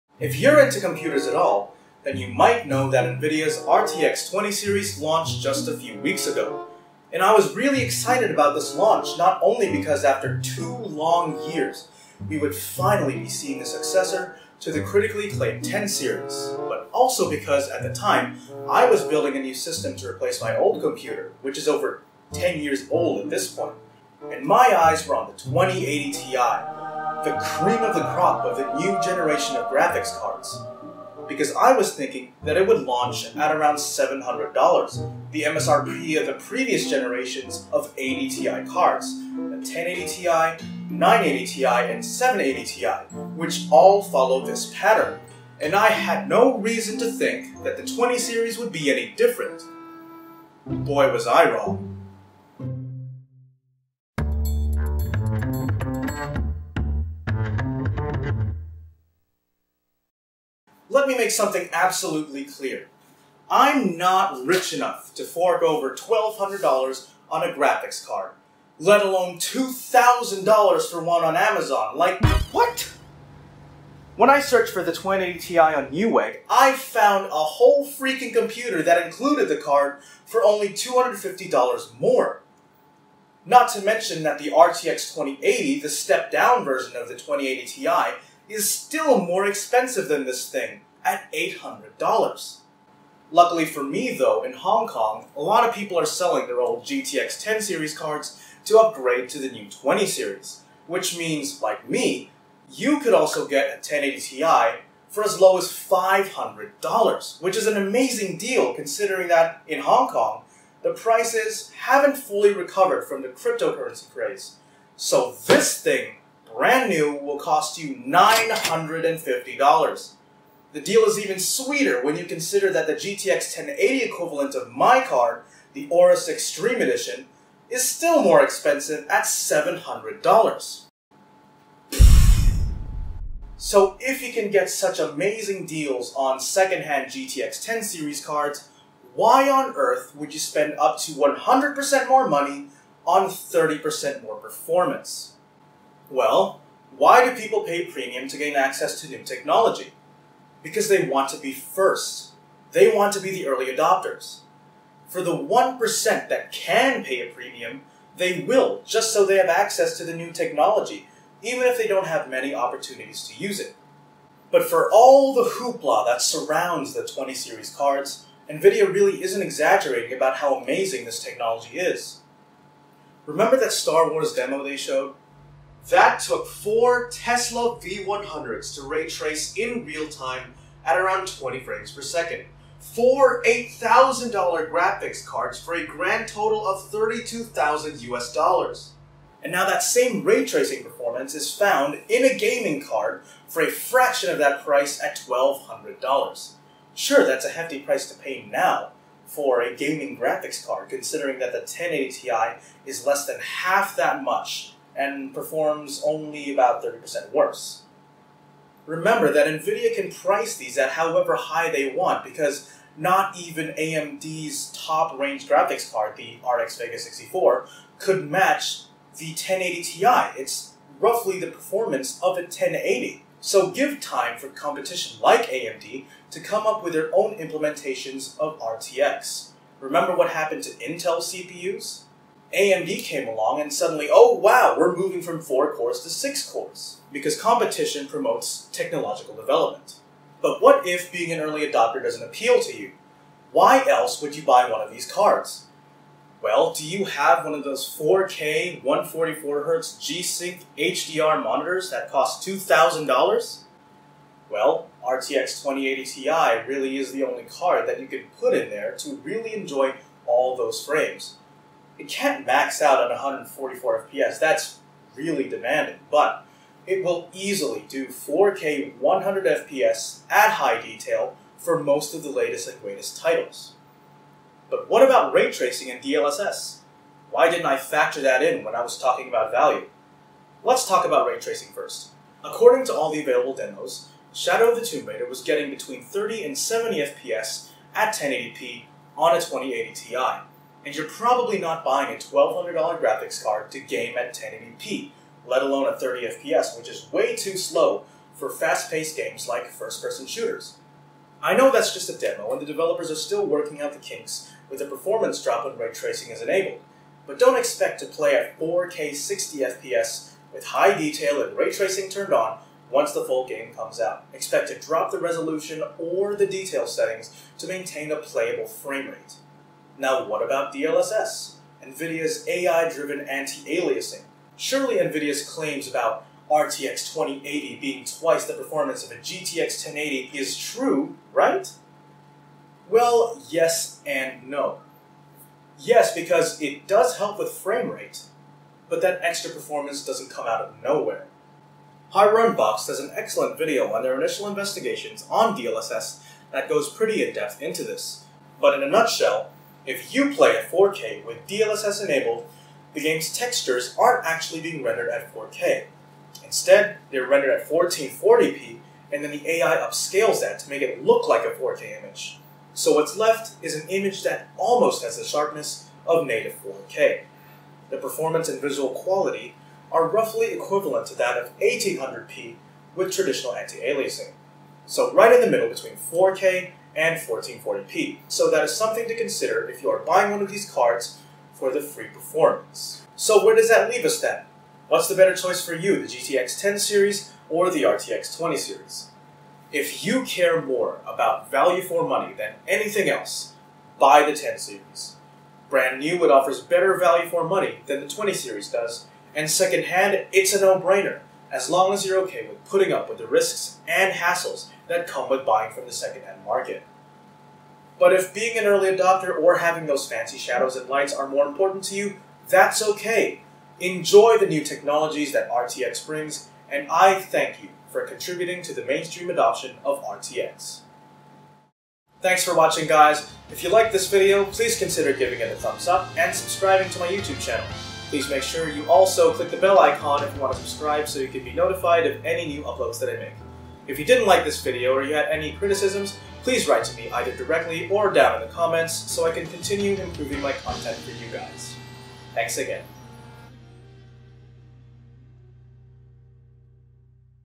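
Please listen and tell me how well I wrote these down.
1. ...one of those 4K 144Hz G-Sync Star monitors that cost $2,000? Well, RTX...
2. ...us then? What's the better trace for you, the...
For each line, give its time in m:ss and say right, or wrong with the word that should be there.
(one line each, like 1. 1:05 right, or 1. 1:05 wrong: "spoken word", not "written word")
1. 4:07 wrong: "HDR", not "Star"
2. 6:24 wrong: "choice", not "trace".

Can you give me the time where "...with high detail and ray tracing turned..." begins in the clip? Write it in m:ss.
5:10.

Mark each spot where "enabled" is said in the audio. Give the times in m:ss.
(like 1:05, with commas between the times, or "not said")
5:06, 5:52.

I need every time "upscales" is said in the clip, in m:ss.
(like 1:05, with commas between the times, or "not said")
5:59.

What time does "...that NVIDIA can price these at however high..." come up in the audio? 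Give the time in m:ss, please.
3:29.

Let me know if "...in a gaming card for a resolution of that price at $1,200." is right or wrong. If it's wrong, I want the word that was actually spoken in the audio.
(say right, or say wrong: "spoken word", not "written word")
wrong: "fraction", not "resolution".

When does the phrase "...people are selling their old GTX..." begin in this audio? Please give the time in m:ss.
1:35.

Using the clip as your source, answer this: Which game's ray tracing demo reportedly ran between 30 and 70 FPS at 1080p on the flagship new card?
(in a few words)
Shadow of the Tomb Raider.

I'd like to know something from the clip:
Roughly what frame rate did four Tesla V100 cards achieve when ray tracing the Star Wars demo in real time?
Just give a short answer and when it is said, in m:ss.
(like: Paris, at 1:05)
20 frames per second, at 3:01.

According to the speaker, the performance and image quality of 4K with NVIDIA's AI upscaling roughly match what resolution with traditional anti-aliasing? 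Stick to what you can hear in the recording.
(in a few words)
1800p.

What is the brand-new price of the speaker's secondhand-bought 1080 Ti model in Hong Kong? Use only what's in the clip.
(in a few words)
$950.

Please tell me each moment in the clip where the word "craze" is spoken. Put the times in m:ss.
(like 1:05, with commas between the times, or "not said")
1:54.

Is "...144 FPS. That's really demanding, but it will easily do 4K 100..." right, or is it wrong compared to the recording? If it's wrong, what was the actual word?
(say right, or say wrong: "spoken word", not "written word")
right.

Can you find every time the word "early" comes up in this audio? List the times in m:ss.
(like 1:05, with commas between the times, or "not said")
2:33, 4:01, 6:48.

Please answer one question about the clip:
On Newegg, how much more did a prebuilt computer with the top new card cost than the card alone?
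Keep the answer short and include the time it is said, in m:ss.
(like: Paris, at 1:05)
$250, at 1:20.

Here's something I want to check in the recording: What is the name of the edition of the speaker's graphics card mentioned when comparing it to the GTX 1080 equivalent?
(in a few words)
Aorus Extreme Edition.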